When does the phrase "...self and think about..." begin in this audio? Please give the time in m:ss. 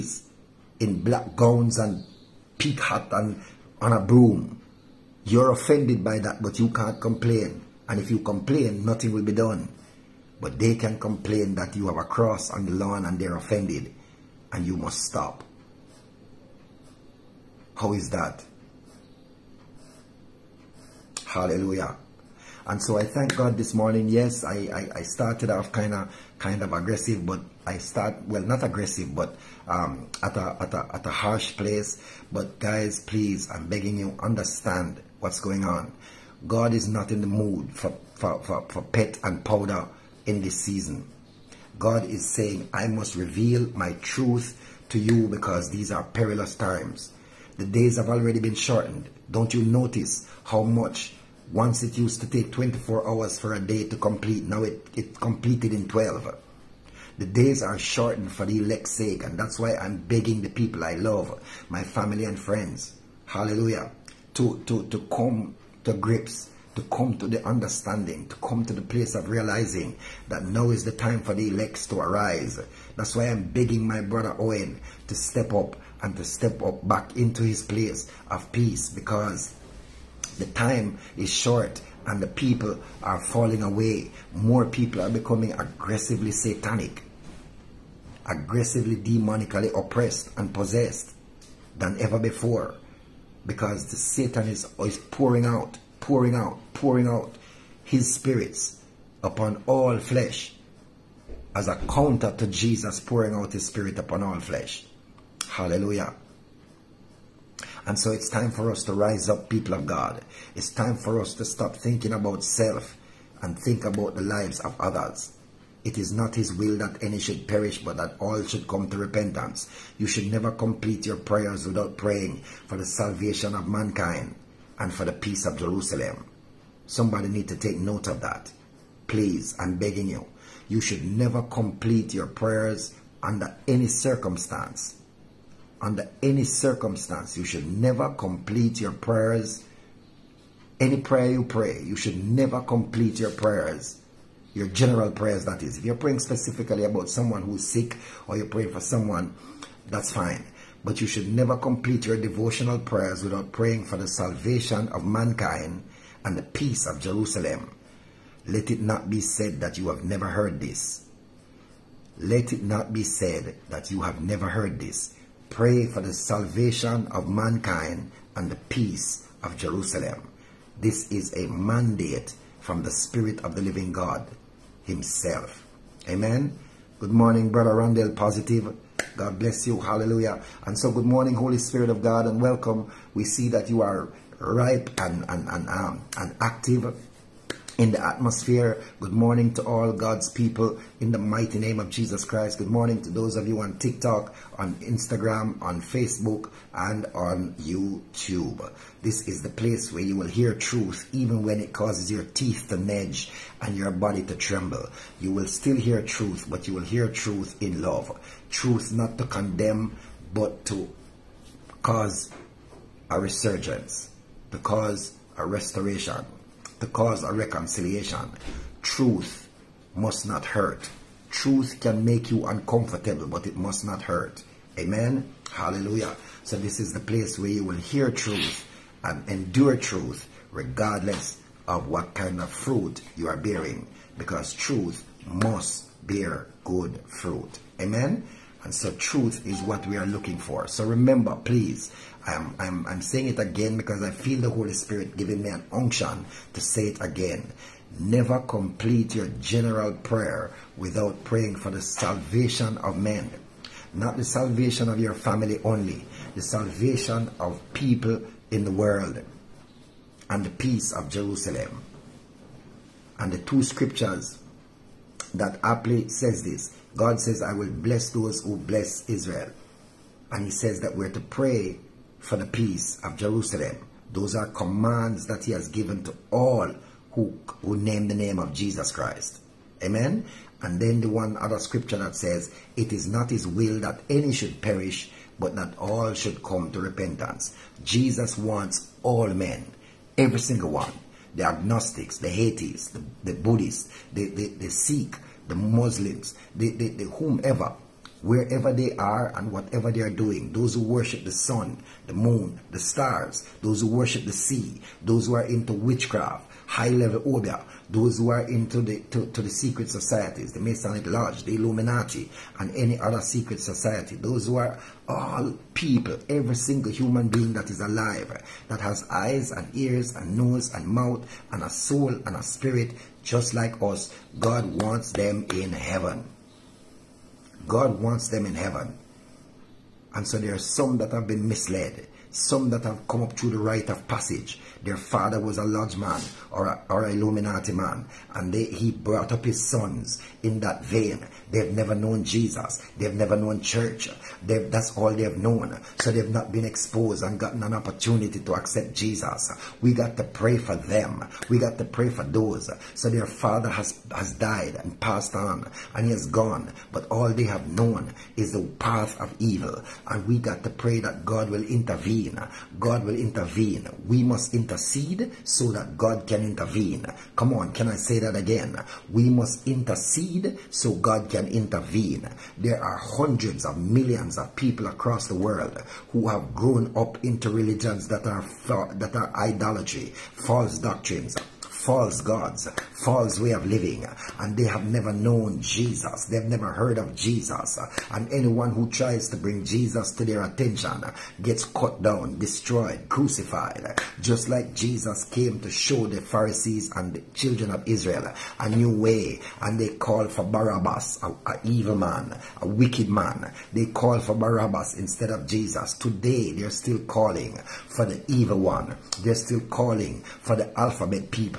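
1:52.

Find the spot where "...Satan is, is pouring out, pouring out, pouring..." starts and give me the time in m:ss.
1:33.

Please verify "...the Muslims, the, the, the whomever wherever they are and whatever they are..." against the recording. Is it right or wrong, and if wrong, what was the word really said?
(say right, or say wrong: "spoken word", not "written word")
right.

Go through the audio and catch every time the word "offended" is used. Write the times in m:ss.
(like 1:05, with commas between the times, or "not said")
0:05, 0:13.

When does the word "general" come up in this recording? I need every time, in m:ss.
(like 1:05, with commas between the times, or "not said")
2:24, 4:09.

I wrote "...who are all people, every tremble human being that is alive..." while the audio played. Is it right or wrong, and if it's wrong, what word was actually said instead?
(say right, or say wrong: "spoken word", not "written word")
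wrong: "single", not "tremble".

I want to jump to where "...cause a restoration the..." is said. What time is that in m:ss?
3:34.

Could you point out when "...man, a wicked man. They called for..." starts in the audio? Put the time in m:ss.
6:41.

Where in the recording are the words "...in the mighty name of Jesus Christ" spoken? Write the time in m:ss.
3:11.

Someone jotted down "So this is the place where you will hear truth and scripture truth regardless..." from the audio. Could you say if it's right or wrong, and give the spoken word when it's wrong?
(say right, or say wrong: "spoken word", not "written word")
wrong: "endure", not "scripture".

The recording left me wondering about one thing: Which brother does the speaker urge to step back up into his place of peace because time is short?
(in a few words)
Owen.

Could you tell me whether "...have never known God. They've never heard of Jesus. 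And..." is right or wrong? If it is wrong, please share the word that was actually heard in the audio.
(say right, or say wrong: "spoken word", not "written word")
wrong: "Jesus", not "God".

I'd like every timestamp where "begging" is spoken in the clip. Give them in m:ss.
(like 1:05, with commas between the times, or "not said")
0:33, 0:59, 1:13, 2:09.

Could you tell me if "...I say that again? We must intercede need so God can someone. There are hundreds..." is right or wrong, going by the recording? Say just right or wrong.
wrong.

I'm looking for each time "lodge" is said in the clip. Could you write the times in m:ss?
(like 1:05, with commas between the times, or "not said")
5:11, 5:35.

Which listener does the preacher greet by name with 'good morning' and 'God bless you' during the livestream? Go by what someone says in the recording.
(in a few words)
Brother Randall Positive.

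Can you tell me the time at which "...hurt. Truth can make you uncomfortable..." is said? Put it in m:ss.
3:40.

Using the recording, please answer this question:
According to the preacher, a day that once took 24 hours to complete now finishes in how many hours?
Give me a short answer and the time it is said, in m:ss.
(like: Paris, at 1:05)
12, at 0:55.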